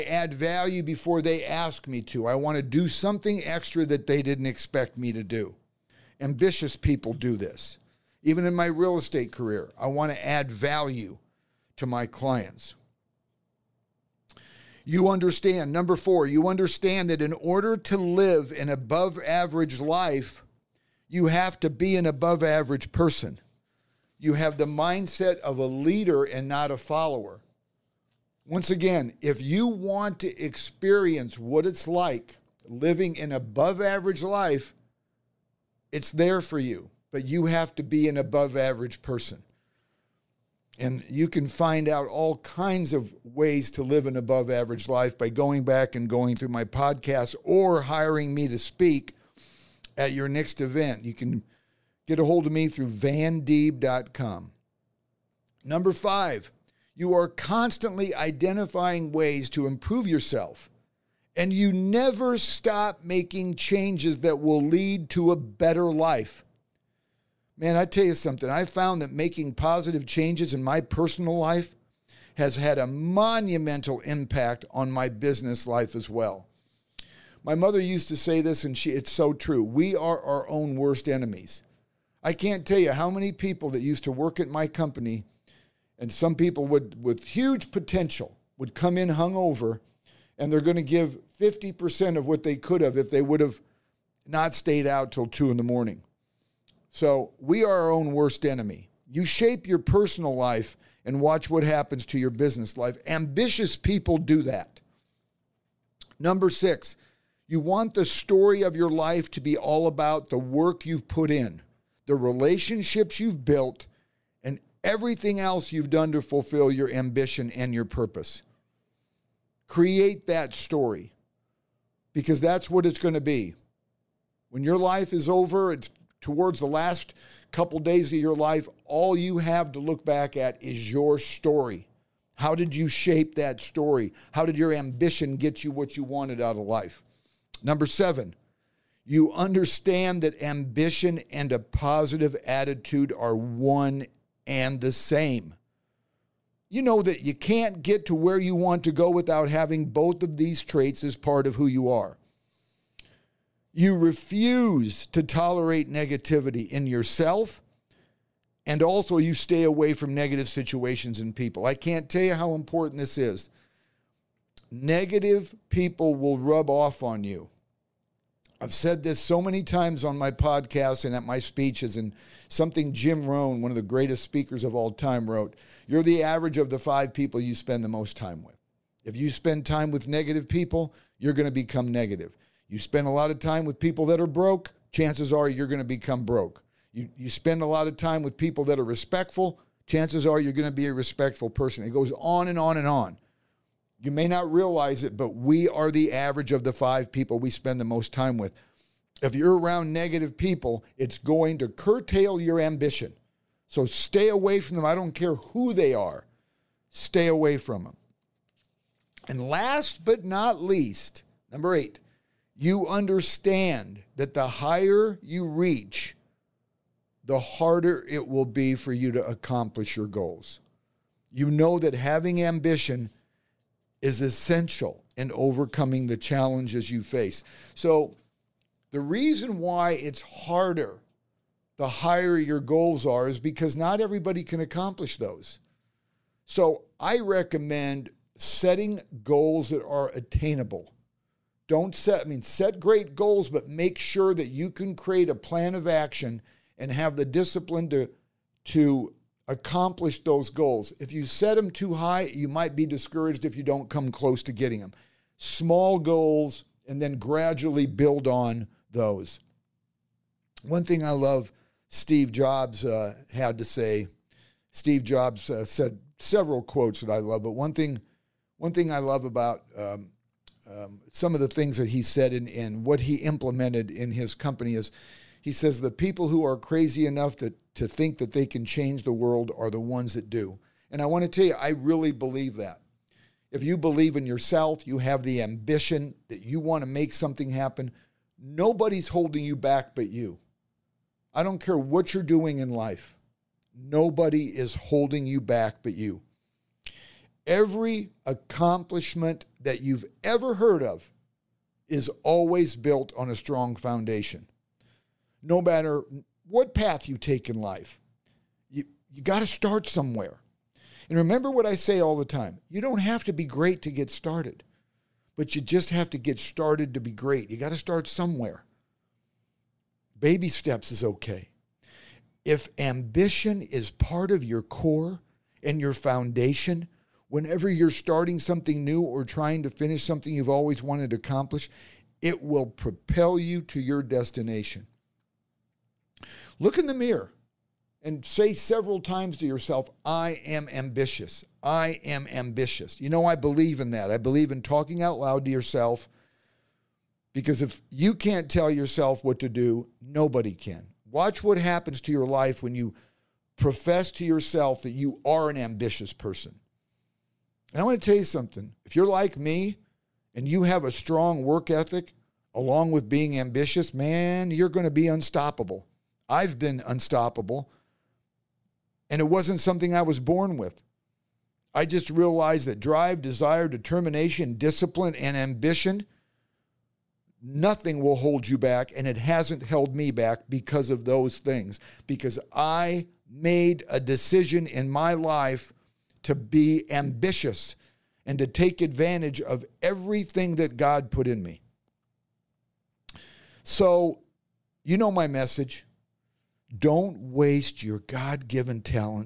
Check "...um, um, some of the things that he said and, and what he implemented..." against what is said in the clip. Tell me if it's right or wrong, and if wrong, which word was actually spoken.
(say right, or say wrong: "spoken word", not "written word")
right.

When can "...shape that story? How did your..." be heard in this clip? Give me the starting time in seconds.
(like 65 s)
132 s.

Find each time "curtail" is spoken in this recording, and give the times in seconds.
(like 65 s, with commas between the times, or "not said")
201 s.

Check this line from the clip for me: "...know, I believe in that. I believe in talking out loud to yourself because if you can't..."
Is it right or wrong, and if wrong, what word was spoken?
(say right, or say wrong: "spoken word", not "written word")
right.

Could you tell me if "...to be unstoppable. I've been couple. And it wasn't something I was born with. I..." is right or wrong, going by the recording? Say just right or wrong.
wrong.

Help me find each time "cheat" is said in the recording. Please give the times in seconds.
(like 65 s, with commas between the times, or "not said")
not said.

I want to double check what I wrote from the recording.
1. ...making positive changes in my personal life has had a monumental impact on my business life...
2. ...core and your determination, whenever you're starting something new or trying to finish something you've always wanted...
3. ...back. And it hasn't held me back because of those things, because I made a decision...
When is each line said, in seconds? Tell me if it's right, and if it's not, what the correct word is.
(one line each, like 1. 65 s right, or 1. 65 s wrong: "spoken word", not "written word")
1. 69 s right
2. 324 s wrong: "foundation", not "determination"
3. 378 s right.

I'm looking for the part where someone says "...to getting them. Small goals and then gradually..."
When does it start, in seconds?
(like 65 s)
254 s.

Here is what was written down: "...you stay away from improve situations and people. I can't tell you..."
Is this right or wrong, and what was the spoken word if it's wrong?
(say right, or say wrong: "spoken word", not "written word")
wrong: "negative", not "improve".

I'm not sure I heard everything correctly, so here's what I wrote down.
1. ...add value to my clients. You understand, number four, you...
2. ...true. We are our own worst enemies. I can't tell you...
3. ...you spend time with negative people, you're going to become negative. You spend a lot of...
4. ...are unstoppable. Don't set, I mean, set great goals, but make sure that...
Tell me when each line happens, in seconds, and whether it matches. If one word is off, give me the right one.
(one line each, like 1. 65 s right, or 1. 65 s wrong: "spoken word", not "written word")
1. 10 s right
2. 79 s right
3. 179 s right
4. 239 s wrong: "attainable", not "unstoppable".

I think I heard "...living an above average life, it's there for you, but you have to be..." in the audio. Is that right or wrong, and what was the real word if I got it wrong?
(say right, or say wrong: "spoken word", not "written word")
right.